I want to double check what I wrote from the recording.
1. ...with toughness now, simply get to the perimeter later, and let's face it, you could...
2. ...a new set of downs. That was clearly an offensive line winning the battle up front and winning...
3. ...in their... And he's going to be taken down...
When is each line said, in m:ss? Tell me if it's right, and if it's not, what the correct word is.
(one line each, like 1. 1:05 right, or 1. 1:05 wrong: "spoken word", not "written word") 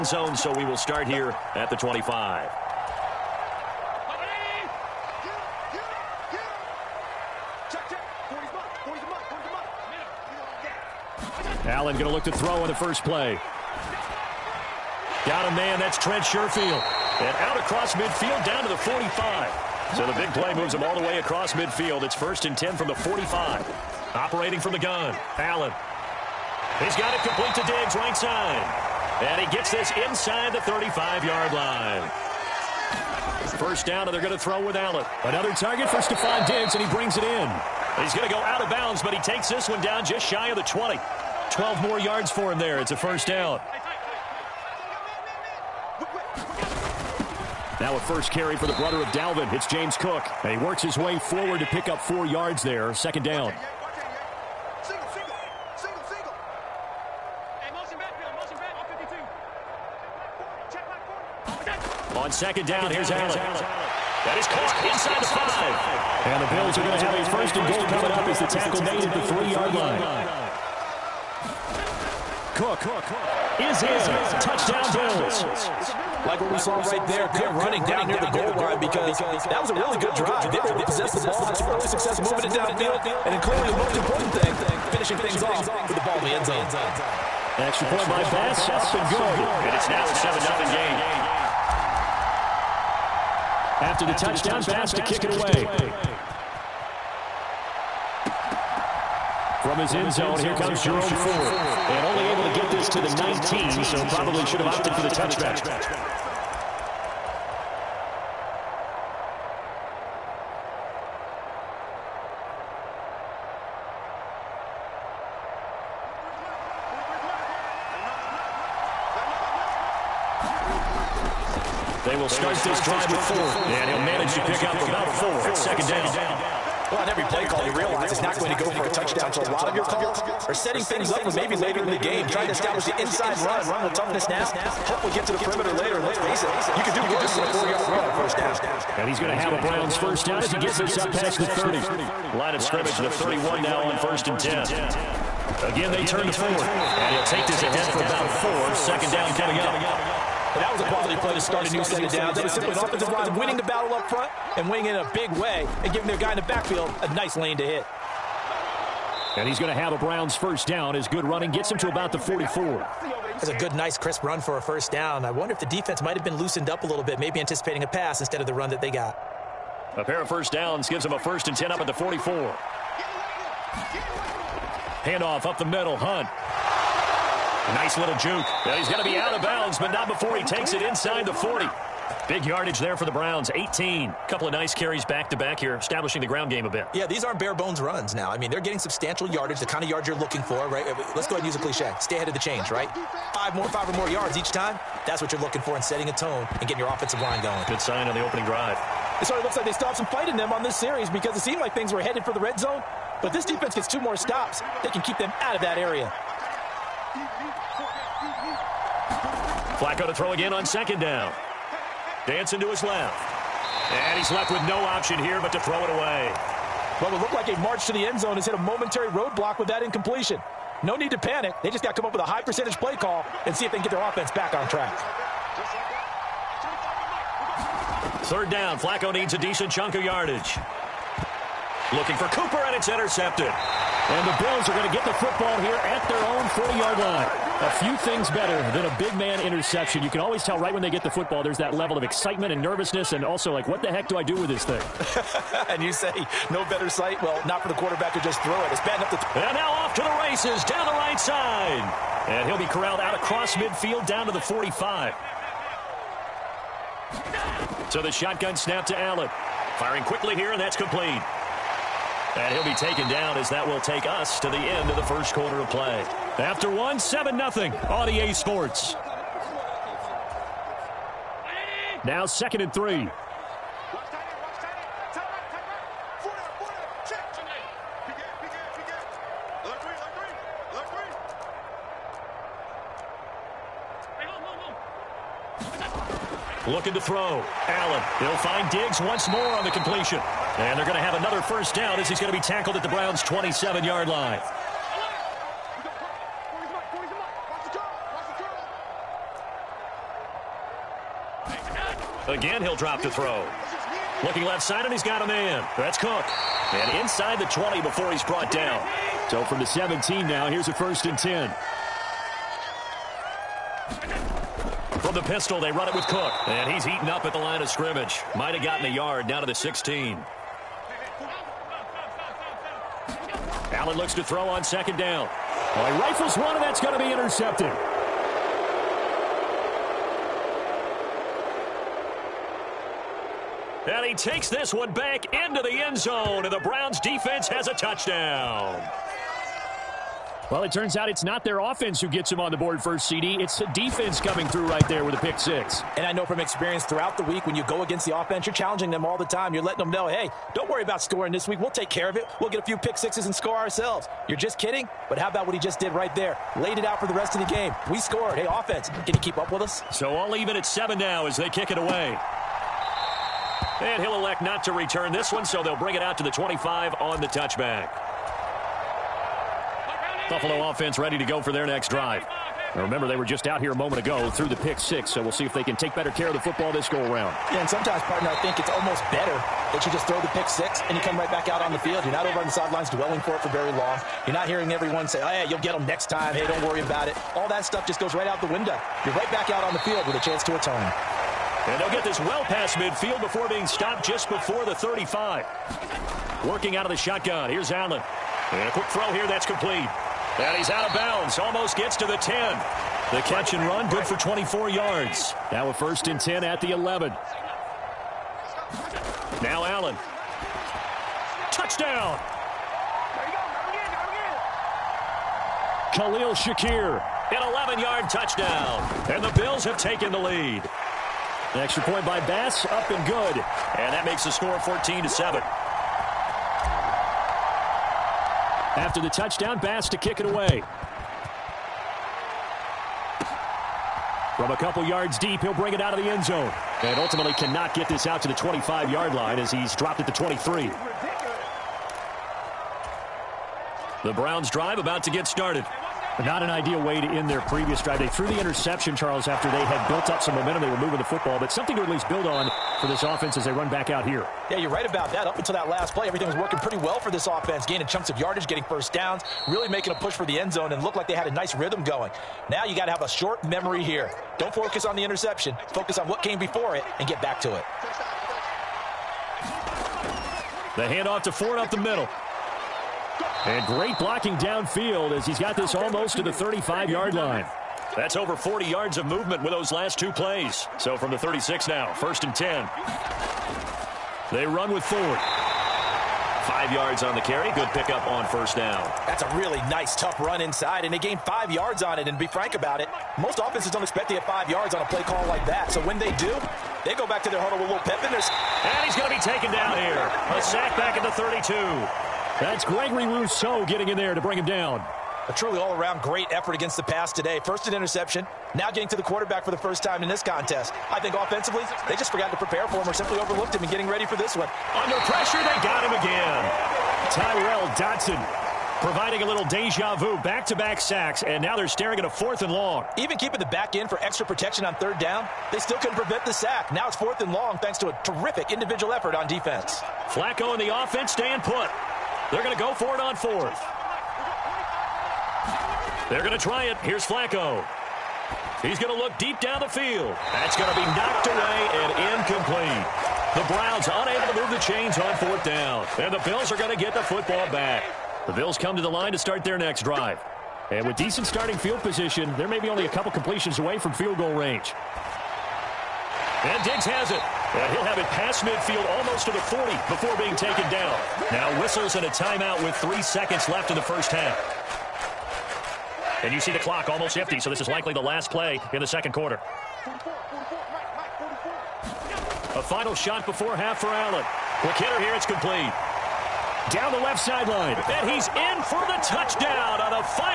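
1. 2:13 wrong: "hopefully", not "simply"
2. 2:31 wrong: "simply", not "clearly"
3. 8:18 right.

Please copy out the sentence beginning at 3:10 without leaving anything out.
Uh, let's go ahead and use a cliche.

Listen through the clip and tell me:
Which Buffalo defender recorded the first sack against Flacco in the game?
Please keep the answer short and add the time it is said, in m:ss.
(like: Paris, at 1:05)
Gregory Rousseau, at 8:22.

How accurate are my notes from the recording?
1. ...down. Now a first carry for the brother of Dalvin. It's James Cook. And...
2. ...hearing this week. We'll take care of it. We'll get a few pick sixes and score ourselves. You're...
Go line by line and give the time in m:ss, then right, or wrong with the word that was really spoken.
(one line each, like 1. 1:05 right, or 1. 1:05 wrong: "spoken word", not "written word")
1. 0:43 right
2. 5:50 wrong: "scoring", not "hearing".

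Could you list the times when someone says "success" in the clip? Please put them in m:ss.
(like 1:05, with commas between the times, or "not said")
1:21.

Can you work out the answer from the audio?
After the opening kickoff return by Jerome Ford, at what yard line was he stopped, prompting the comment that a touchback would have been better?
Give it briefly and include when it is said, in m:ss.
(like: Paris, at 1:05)
19, at 1:43.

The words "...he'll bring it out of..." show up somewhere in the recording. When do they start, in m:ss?
7:15.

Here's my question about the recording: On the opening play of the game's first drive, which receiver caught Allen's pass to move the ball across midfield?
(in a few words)
Trent Sherfield.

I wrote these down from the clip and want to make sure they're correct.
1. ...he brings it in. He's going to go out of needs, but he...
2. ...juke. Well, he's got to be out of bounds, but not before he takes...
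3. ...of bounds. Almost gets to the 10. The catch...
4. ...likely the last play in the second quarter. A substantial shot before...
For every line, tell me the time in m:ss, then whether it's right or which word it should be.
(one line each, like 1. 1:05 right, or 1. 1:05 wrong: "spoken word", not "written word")
1. 0:36 wrong: "bounds", not "needs"
2. 2:58 right
3. 6:40 right
4. 9:27 wrong: "final", not "substantial".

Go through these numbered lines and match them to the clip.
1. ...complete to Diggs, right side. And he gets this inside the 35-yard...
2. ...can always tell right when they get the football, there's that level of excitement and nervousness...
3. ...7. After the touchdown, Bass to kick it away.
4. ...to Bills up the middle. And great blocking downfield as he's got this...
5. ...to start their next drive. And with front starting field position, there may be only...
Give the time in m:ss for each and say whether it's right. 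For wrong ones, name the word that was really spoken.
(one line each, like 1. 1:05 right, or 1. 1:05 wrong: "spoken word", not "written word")
1. 0:27 right
2. 4:00 right
3. 7:05 right
4. 7:51 wrong: "Ford", not "Bills"
5. 9:09 wrong: "decent", not "front".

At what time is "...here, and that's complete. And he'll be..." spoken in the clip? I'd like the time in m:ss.
4:20.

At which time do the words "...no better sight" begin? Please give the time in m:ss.
4:06.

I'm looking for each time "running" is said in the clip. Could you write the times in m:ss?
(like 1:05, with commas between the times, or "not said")
1:17, 2:41.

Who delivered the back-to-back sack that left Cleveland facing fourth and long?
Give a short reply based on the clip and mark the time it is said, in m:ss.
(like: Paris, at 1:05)
Tyrel Dodson, at 8:37.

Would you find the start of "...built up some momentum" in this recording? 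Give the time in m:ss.
7:29.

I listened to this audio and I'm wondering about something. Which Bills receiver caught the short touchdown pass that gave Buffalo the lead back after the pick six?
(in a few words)
Khalil Shakir.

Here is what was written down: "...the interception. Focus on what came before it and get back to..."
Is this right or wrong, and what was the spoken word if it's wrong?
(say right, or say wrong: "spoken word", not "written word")
right.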